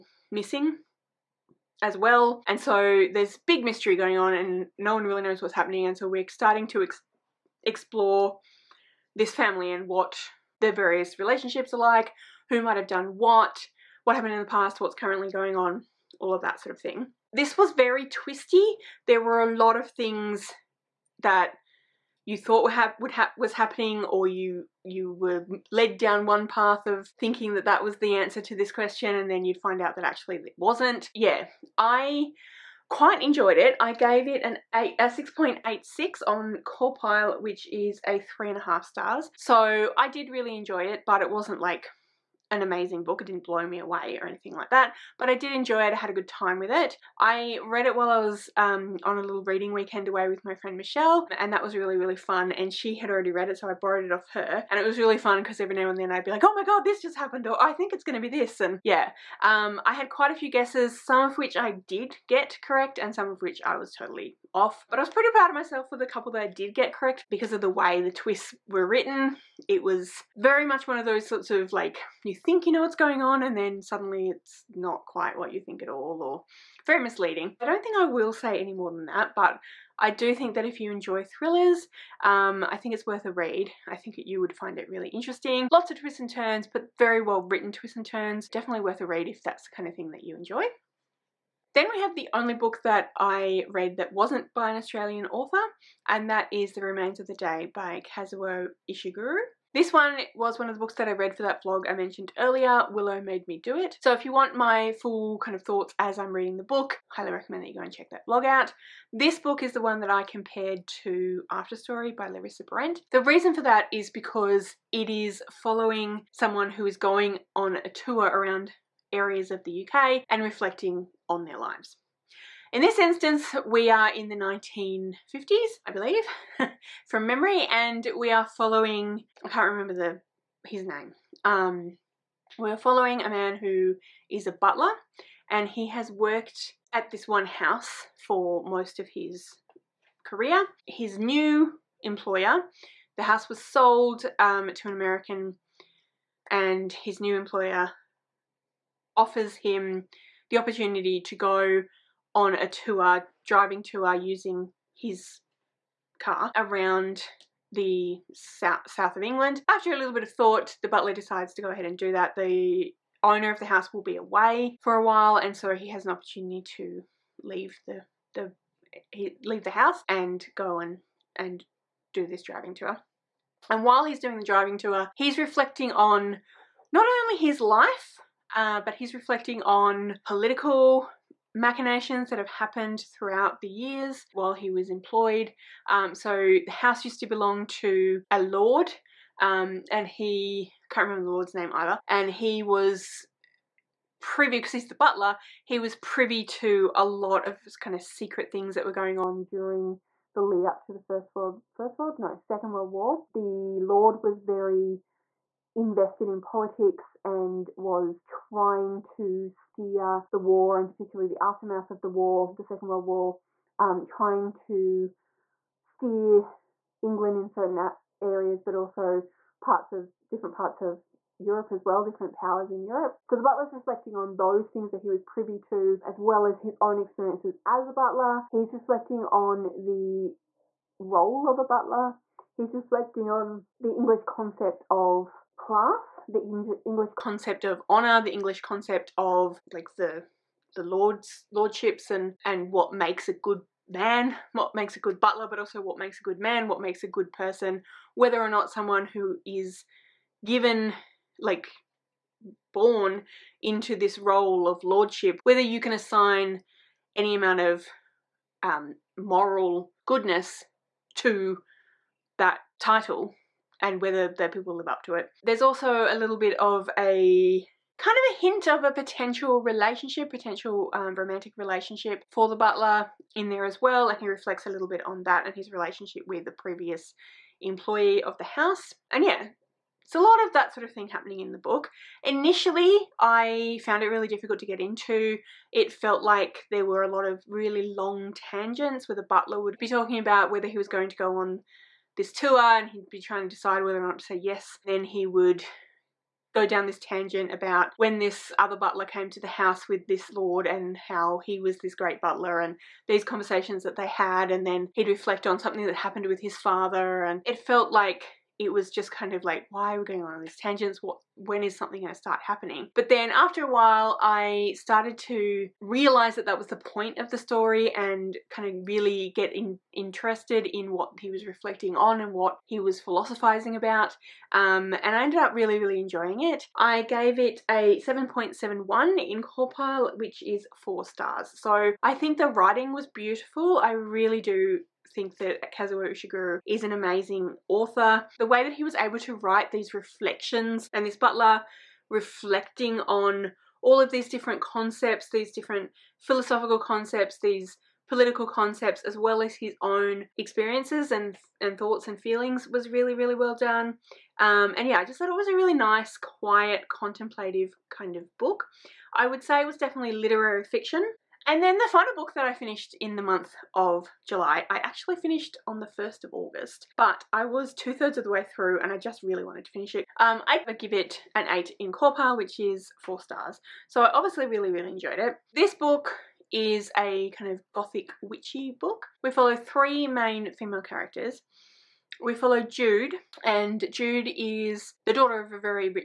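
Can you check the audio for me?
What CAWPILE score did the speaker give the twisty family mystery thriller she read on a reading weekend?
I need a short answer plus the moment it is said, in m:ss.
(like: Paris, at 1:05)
6.86, at 0:35.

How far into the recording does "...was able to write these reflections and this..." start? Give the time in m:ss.
5:38.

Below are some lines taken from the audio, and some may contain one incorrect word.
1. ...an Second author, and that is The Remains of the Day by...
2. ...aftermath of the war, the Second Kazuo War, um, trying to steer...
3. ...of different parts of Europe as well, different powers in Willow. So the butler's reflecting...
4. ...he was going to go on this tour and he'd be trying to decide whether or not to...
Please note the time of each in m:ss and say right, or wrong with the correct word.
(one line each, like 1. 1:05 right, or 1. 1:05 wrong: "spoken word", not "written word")
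1. 1:34 wrong: "Australian", not "Second"
2. 3:31 wrong: "World", not "Kazuo"
3. 3:39 wrong: "Europe", not "Willow"
4. 4:50 right.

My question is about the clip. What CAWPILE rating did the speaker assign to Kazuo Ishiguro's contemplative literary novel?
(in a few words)
7.71.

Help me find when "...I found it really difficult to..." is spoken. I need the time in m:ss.
4:43.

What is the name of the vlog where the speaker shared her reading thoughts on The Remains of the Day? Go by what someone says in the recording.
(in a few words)
Willow Made Me Do It.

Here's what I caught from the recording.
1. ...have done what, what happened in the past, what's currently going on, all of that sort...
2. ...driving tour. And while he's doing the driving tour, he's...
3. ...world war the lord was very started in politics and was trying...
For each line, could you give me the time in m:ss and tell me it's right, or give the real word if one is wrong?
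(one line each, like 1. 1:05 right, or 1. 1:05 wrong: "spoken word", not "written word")
1. 0:12 right
2. 2:52 right
3. 3:22 wrong: "invested", not "started".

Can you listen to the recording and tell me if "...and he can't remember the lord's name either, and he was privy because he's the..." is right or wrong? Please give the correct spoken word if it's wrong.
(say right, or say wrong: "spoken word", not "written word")
right.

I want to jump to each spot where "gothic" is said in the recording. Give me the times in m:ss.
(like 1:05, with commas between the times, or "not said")
6:17.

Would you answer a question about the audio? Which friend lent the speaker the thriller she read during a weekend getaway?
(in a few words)
Michelle.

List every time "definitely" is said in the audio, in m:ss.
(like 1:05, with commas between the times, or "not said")
1:28, 5:59.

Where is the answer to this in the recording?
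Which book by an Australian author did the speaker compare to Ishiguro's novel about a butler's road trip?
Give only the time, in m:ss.
1:51.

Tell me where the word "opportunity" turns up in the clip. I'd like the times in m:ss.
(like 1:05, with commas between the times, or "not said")
2:30, 2:46.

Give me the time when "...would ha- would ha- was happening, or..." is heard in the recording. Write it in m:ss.
0:22.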